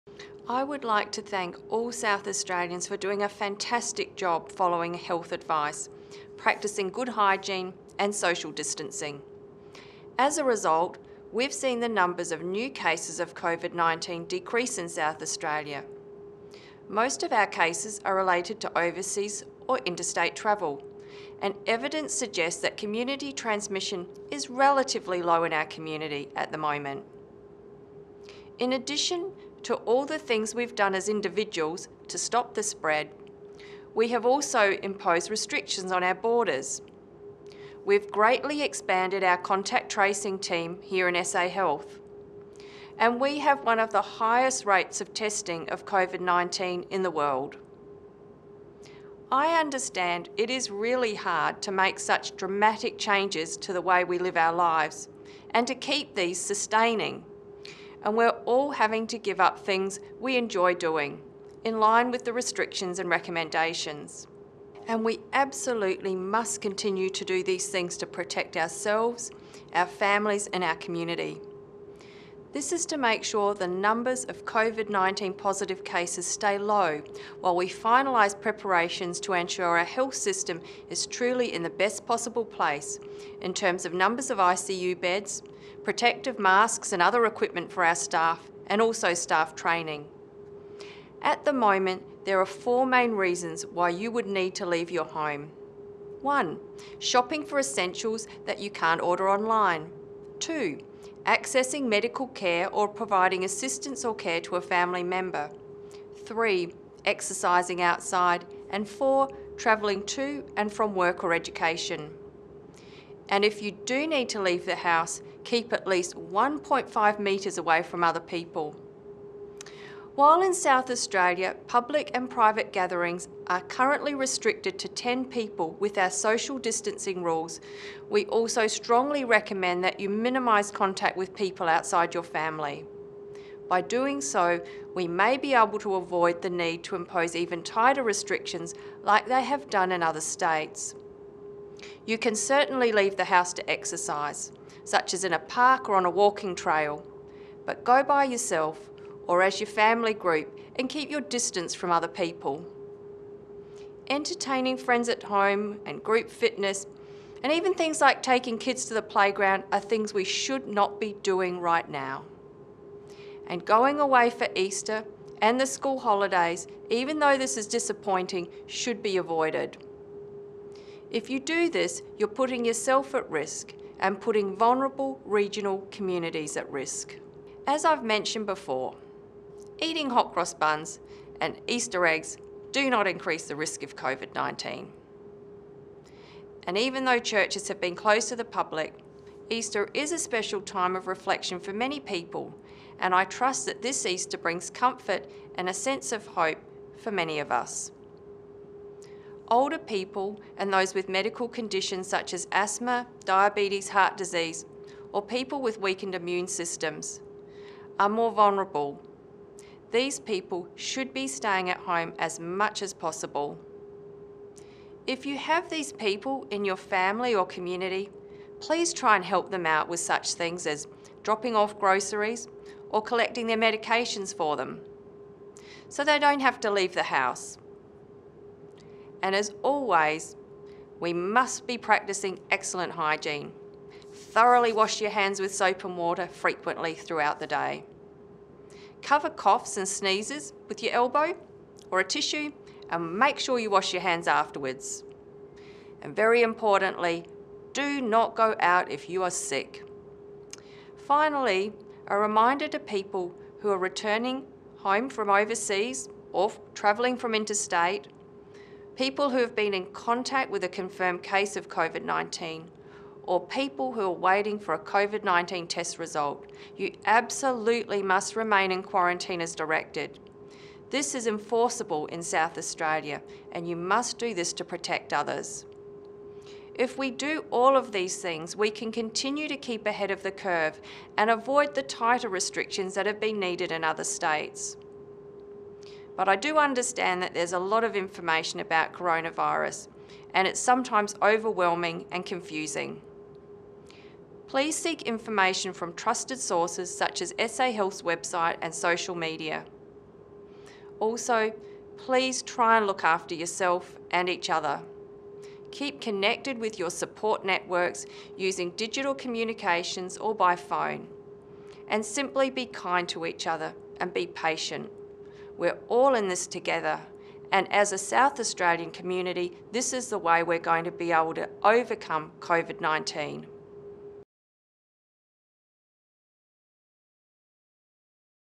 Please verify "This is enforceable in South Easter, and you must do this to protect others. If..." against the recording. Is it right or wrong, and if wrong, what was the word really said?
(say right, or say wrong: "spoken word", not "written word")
wrong: "Australia", not "Easter".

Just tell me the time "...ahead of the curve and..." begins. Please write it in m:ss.
4:39.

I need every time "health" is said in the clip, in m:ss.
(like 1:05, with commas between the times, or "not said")
0:04, 0:41, 1:19, 4:57.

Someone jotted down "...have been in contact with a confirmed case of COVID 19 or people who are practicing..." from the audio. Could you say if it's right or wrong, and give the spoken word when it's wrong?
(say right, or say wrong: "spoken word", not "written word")
wrong: "waiting", not "practicing".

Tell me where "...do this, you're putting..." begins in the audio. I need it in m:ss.
2:51.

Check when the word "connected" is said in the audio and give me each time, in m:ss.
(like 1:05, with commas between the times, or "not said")
5:06.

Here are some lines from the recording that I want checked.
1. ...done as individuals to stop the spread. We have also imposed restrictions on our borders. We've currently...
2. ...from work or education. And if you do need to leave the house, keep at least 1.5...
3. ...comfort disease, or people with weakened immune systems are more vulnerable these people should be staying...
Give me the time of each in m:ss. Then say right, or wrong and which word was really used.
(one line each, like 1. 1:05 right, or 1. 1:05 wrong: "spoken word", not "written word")
1. 0:30 wrong: "greatly", not "currently"
2. 1:50 right
3. 3:23 wrong: "heart", not "comfort".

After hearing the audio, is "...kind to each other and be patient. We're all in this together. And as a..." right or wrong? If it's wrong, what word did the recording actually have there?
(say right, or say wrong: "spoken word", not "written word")
right.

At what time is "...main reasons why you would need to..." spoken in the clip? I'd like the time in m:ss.
1:32.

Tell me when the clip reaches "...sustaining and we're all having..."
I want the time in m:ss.
0:56.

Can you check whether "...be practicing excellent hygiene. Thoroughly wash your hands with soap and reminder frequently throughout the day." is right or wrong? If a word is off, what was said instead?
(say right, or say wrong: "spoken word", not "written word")
wrong: "water", not "reminder".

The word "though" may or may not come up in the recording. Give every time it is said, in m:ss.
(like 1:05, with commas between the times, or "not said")
2:47, 3:07.